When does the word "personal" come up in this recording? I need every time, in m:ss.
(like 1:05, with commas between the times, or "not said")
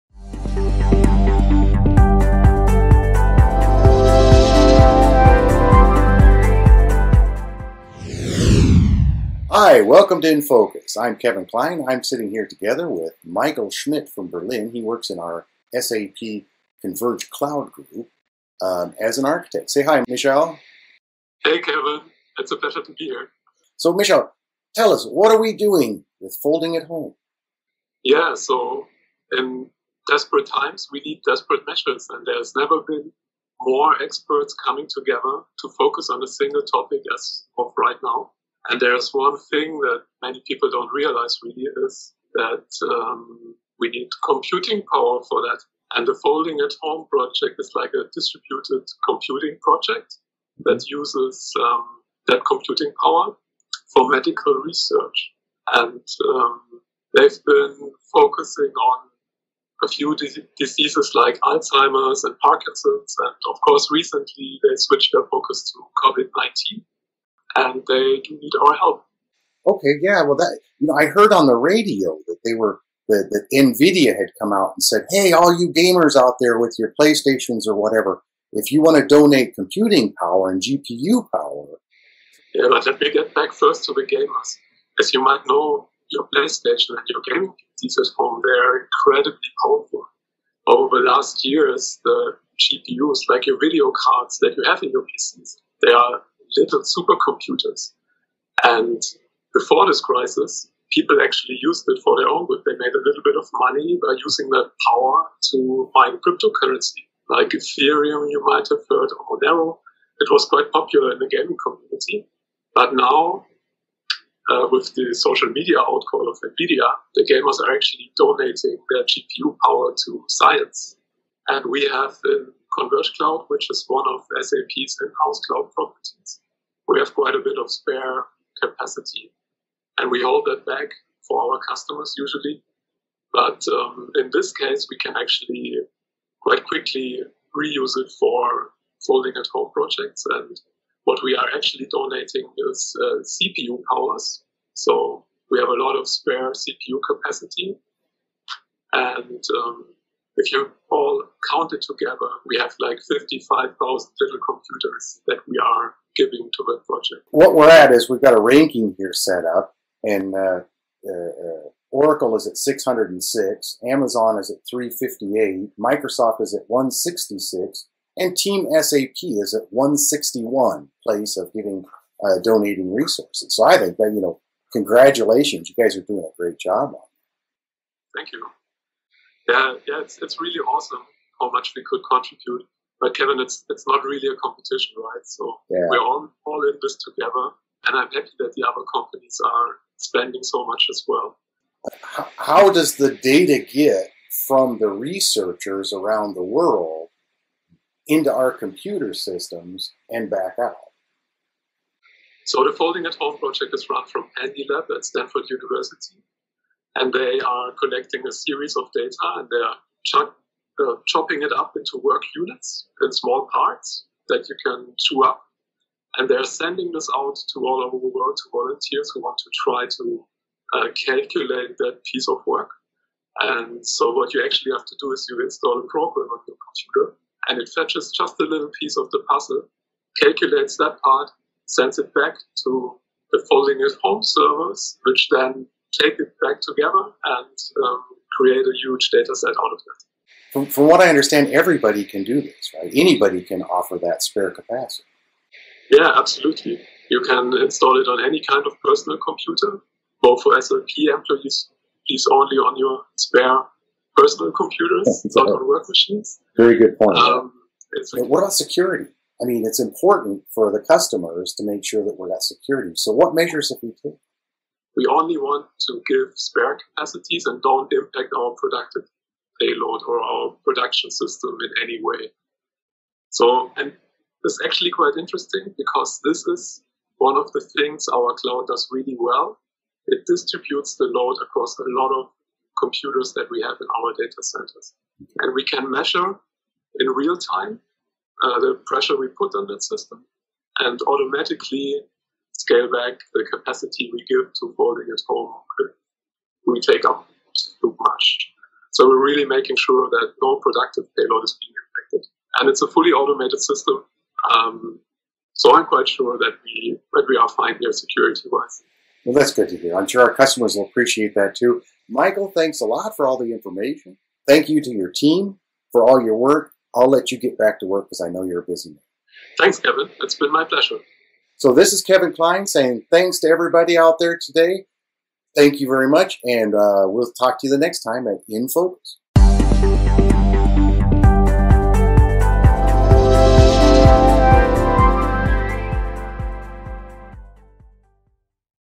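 4:08, 4:14.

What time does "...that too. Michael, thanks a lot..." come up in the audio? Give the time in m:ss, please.
5:11.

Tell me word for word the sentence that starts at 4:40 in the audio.
It distributes the load across a lot of computers that we have in our data centers.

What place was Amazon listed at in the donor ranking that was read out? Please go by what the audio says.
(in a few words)
358.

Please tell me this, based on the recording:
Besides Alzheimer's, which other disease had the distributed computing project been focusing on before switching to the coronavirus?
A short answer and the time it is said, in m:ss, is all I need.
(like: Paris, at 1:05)
Parkinson's, at 1:02.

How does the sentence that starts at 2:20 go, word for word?
And what we are actually donating is uh, CPU powers.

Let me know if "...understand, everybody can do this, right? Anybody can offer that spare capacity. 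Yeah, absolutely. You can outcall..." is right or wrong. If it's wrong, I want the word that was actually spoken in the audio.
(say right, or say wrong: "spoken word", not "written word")
wrong: "install", not "outcall".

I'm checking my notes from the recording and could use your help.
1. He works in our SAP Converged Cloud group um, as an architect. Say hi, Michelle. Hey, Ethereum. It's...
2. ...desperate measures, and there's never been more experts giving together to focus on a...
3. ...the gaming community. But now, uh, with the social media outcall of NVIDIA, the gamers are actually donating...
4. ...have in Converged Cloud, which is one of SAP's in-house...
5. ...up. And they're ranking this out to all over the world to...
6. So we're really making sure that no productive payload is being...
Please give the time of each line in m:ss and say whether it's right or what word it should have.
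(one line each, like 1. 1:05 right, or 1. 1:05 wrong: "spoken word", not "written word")
1. 0:14 wrong: "Kevin", not "Ethereum"
2. 0:31 wrong: "coming", not "giving"
3. 1:51 right
4. 2:01 right
5. 3:35 wrong: "sending", not "ranking"
6. 4:58 right.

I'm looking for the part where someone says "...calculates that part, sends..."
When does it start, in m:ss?
3:50.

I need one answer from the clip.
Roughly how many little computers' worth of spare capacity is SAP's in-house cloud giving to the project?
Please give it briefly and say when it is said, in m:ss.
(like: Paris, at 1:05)
55,000, at 2:33.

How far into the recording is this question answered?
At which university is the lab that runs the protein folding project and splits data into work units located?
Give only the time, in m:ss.
3:25.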